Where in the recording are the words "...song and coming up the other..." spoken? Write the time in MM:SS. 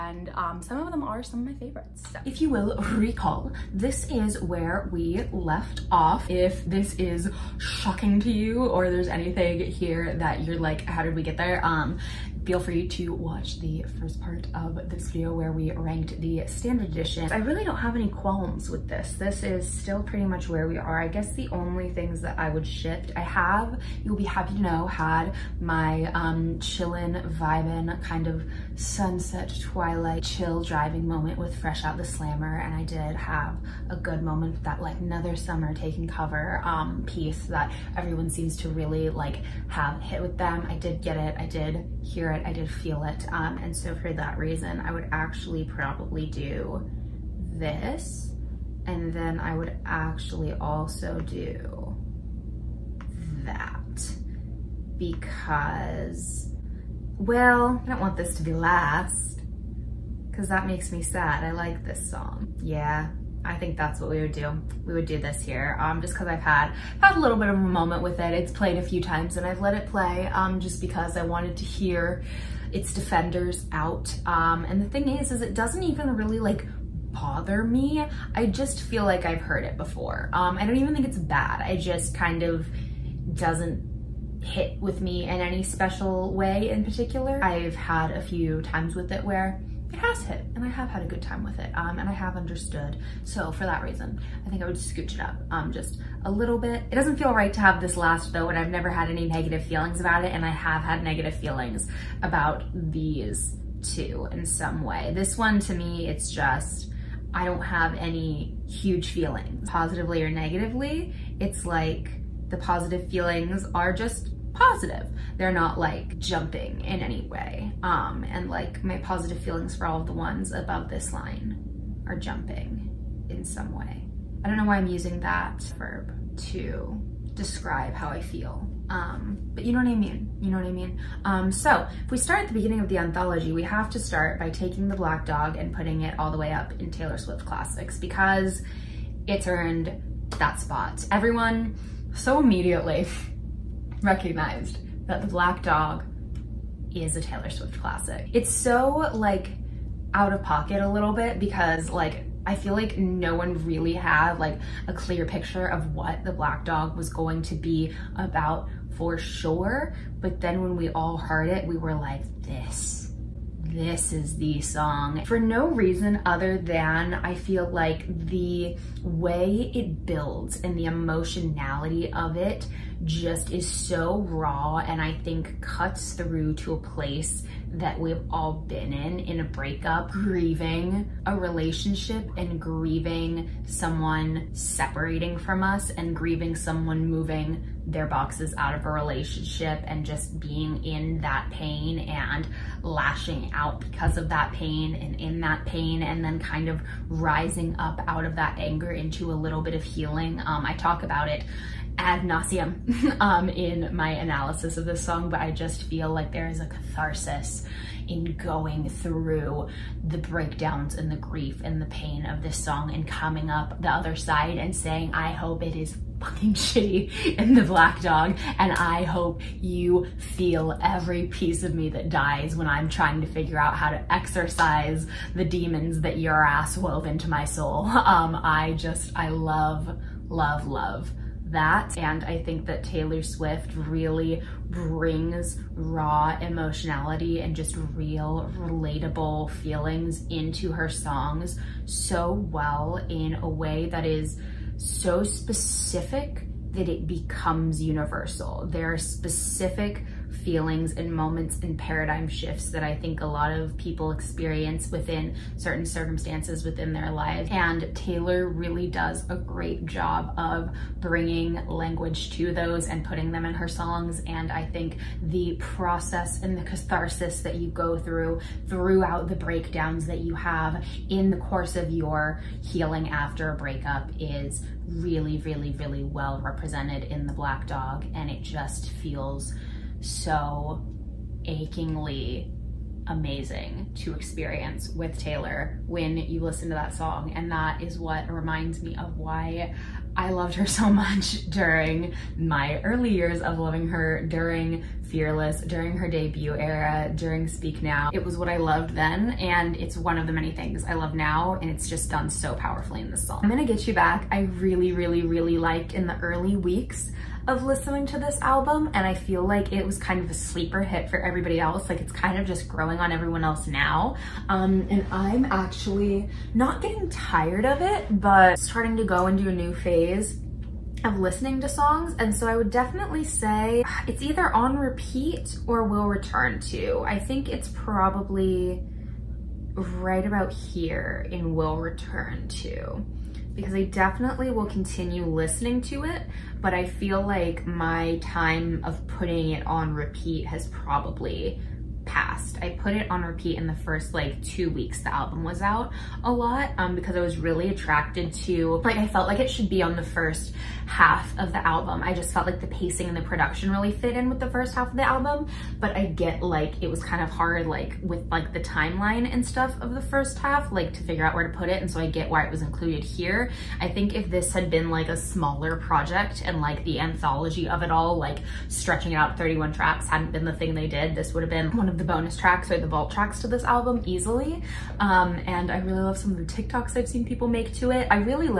03:32.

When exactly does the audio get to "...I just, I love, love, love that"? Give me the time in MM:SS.
03:48.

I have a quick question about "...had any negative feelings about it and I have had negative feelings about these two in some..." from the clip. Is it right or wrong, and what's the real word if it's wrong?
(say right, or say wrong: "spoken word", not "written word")
right.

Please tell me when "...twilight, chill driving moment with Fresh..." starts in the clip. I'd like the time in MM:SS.
00:29.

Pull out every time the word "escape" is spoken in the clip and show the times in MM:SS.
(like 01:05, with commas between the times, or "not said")
not said.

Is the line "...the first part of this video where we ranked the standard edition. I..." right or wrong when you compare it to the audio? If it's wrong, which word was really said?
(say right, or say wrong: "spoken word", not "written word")
right.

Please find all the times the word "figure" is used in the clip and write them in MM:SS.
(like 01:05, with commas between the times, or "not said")
03:43, 06:01.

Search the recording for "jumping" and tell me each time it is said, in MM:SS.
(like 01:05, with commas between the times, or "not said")
01:56, 02:02.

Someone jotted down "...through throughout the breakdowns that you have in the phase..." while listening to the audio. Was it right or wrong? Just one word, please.
wrong.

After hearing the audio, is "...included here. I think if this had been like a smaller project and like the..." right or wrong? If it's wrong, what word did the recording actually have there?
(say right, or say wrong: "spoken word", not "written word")
right.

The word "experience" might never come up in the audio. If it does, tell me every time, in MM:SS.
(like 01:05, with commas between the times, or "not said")
04:14, 04:44.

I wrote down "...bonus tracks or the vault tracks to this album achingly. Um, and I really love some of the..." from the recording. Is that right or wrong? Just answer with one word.
wrong.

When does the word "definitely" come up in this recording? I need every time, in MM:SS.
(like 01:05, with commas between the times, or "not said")
05:22, 05:33.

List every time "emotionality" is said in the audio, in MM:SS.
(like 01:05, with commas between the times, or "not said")
02:50, 03:56.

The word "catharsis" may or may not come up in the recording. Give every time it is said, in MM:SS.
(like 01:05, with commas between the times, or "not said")
03:26, 04:26.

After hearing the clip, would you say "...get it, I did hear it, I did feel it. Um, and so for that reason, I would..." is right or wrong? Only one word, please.
right.